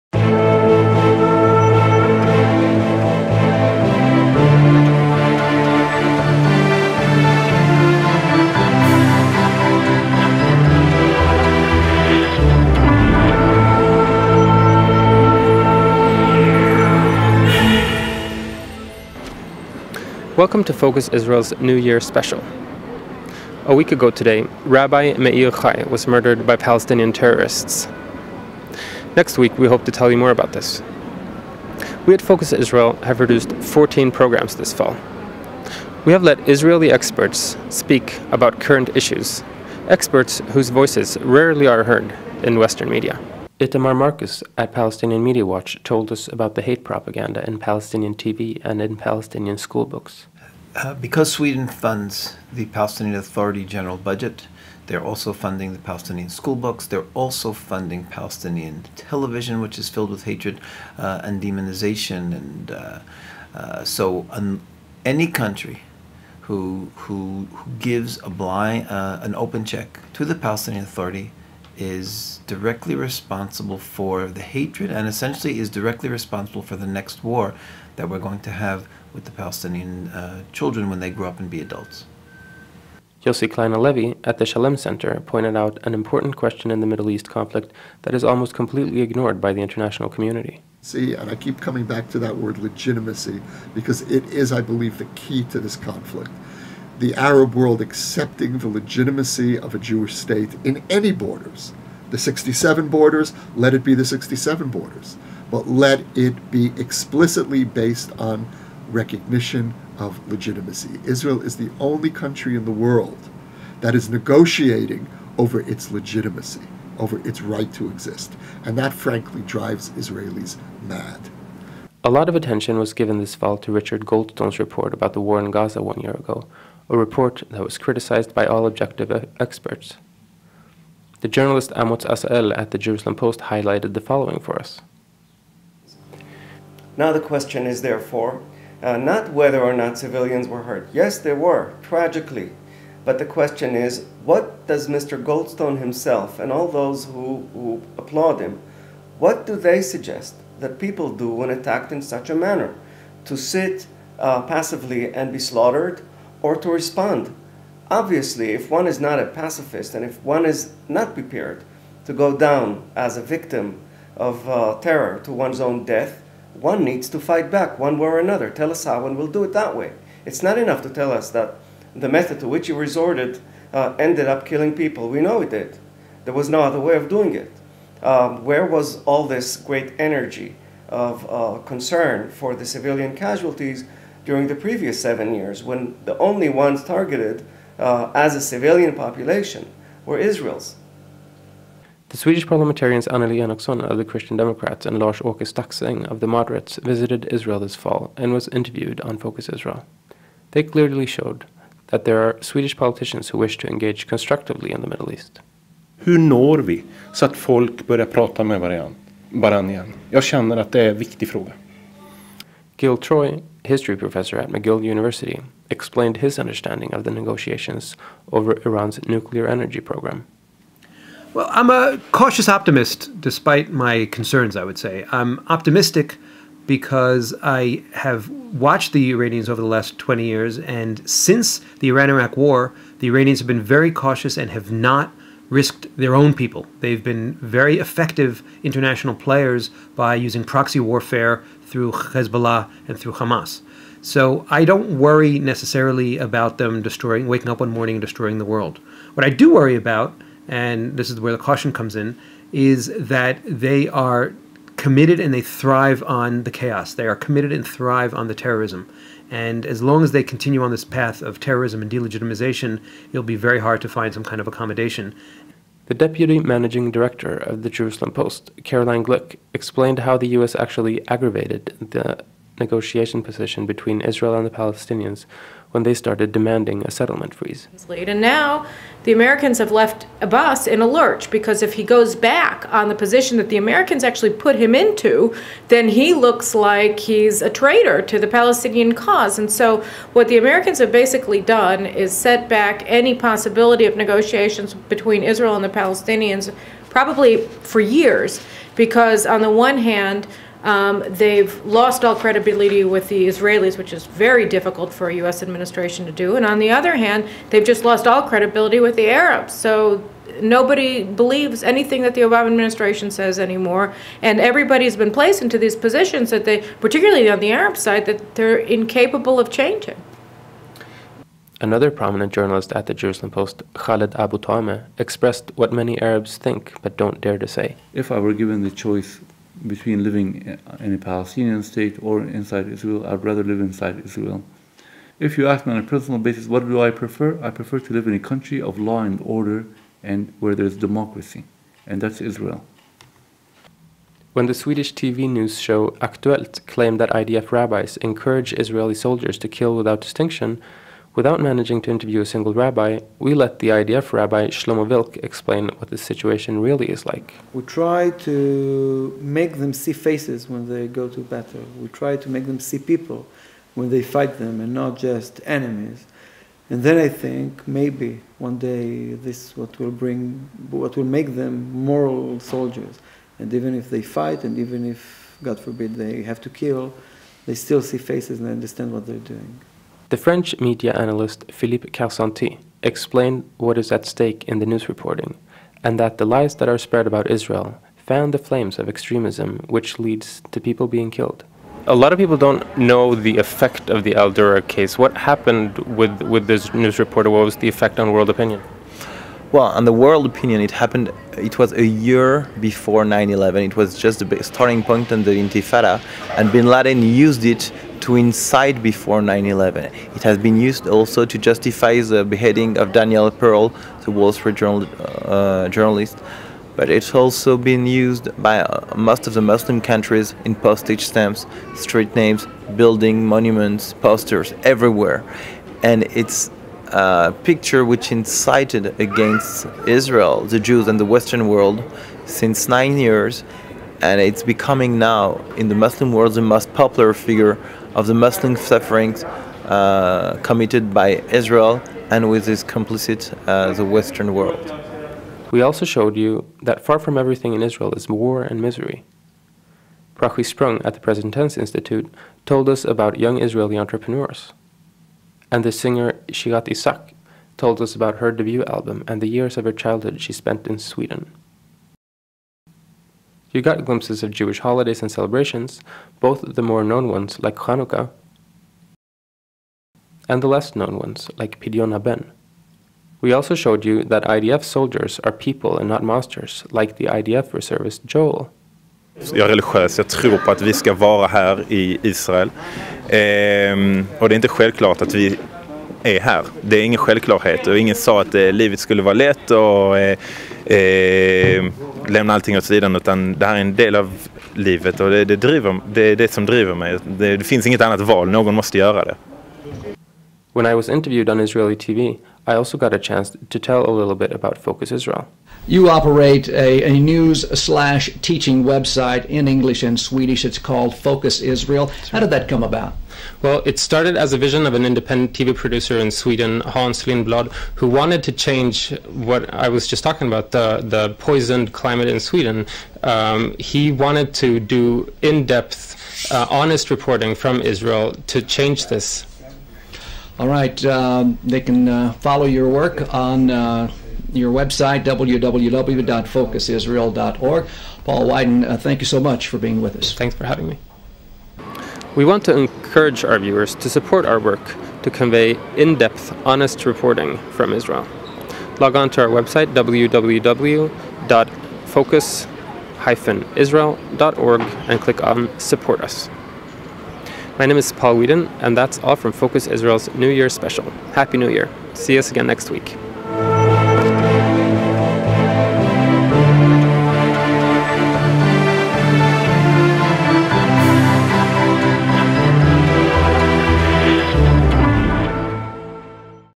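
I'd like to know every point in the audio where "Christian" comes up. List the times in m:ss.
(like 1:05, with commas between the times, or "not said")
3:14.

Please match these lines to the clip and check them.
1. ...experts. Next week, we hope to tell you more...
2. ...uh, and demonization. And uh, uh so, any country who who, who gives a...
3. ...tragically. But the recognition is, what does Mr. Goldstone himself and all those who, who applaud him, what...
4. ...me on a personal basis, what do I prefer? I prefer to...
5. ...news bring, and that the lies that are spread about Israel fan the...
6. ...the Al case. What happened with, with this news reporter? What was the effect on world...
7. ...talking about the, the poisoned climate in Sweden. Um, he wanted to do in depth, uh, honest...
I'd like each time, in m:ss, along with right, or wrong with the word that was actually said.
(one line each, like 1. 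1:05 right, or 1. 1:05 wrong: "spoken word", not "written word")
1. 0:27 wrong: "terrorists", not "experts"
2. 1:00 right
3. 2:21 wrong: "question", not "recognition"
4. 5:35 right
5. 6:24 wrong: "reporting", not "bring"
6. 6:34 right
7. 8:40 right.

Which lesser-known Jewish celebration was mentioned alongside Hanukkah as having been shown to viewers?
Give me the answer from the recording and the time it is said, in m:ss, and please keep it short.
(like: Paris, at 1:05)
Pidyon HaBen, at 7:51.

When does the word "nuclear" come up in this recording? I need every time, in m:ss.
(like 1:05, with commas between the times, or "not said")
3:39.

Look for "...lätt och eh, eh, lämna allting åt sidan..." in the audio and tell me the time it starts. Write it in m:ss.
8:09.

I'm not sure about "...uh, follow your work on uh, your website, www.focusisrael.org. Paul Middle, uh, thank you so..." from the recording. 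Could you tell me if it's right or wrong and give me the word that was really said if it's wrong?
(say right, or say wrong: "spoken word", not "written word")
wrong: "Wyden", not "Middle".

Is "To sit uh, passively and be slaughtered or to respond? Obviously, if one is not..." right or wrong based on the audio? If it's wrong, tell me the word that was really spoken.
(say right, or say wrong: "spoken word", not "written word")
right.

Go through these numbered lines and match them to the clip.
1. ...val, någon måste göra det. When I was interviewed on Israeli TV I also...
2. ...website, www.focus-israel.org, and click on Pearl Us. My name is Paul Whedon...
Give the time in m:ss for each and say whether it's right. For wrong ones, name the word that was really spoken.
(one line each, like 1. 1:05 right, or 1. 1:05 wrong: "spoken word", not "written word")
1. 8:18 right
2. 9:09 wrong: "Support", not "Pearl".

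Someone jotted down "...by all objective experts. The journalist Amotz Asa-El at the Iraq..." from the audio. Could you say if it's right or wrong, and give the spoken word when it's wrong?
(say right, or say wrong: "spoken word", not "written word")
wrong: "Jerusalem", not "Iraq".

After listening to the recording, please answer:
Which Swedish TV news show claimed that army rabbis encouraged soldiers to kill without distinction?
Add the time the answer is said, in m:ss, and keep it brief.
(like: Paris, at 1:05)
Aktuellt, at 5:46.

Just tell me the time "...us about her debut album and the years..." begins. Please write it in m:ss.
7:37.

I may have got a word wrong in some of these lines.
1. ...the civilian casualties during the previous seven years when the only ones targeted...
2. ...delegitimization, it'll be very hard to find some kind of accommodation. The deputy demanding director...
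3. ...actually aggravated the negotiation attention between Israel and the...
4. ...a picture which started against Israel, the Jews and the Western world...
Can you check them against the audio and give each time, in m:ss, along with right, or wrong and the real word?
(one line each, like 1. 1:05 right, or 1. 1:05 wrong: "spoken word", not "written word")
1. 3:02 right
2. 4:21 wrong: "managing", not "demanding"
3. 4:30 wrong: "position", not "attention"
4. 7:06 wrong: "incited", not "started".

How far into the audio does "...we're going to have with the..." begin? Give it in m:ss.
1:18.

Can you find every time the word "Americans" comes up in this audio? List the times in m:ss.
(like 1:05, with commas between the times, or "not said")
4:39, 4:43, 4:50.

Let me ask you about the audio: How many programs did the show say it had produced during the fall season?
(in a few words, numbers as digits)
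14.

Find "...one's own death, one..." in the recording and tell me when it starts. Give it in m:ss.
2:45.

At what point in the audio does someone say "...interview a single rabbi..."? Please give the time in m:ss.
5:51.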